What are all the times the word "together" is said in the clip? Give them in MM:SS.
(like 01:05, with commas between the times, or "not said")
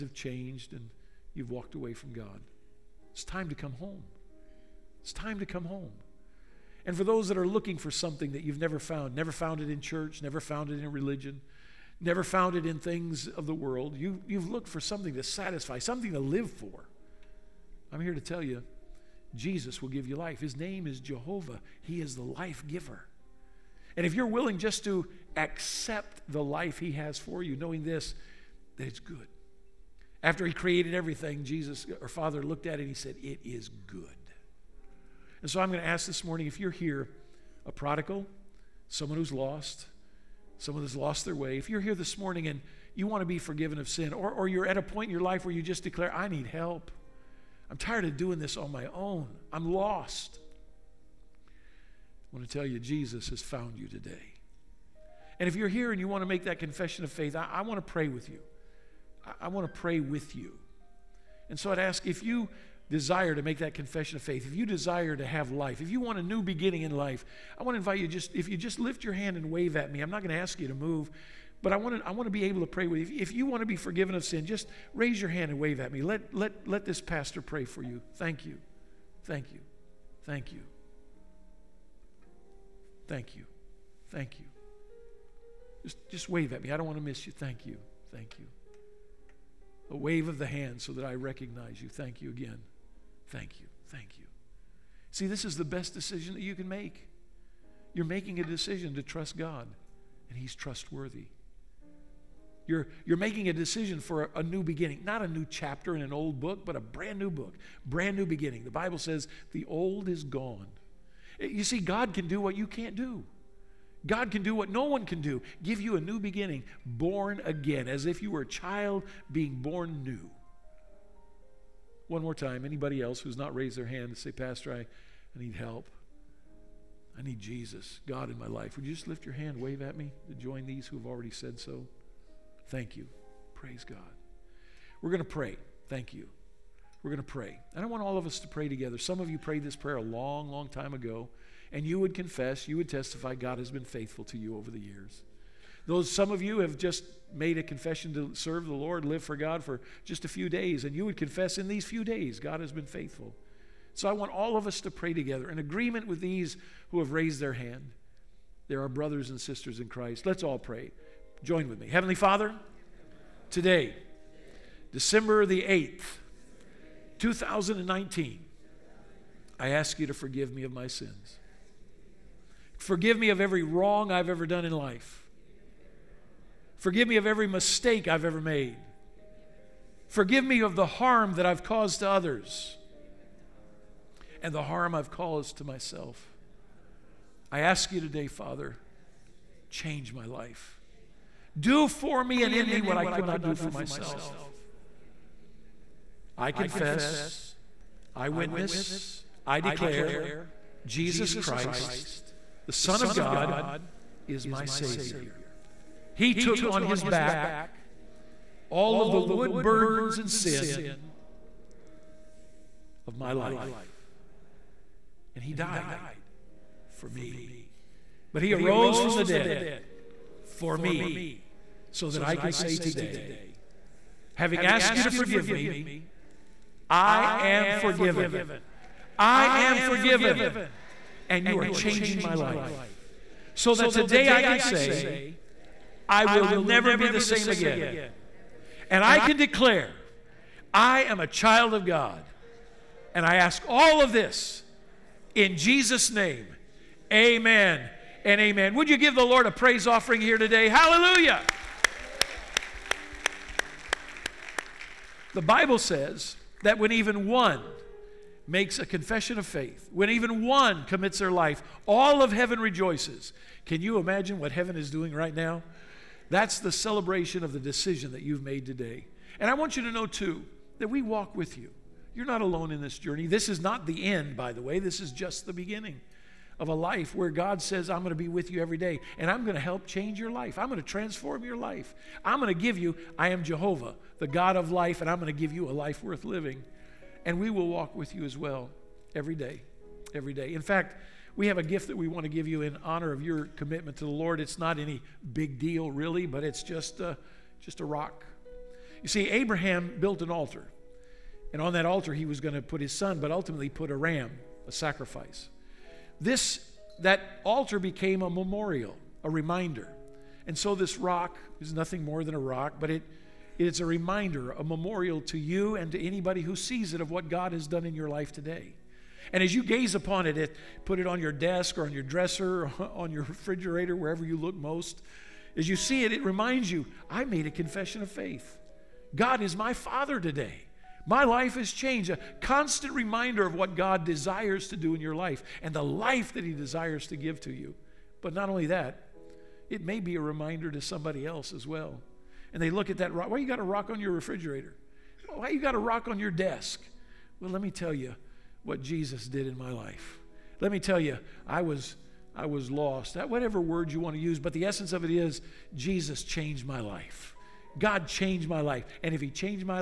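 02:18, 02:35.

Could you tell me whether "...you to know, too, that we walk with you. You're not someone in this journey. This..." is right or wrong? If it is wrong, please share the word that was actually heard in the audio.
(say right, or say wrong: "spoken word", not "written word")
wrong: "alone", not "someone".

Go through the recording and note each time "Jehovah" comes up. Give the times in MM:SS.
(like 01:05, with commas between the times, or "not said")
00:20, 04:43.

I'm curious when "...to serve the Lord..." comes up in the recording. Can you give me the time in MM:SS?
02:28.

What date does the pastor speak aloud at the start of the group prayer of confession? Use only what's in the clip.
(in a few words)
December 8, 2019.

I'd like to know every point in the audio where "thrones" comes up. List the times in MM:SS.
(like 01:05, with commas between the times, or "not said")
not said.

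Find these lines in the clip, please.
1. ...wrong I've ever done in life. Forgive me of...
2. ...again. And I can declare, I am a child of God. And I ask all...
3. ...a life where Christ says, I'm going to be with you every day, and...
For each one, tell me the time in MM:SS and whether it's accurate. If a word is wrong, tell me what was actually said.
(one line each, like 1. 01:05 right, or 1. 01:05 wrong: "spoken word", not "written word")
1. 02:53 right
2. 03:57 right
3. 04:36 wrong: "God", not "Christ".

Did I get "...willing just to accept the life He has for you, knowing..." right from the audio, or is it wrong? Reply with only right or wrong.
right.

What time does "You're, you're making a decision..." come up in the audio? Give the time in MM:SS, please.
01:42.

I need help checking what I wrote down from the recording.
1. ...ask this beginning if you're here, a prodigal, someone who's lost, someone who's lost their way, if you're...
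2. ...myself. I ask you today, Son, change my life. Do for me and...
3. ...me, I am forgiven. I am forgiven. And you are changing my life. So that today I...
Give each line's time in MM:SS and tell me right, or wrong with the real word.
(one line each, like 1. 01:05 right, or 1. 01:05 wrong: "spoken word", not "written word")
1. 00:35 wrong: "morning", not "beginning"
2. 03:05 wrong: "Father", not "Son"
3. 03:45 right.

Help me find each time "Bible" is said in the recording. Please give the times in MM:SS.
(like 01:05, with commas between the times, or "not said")
01:48, 04:15.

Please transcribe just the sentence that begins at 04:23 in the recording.
Can you imagine what heaven is doing right now?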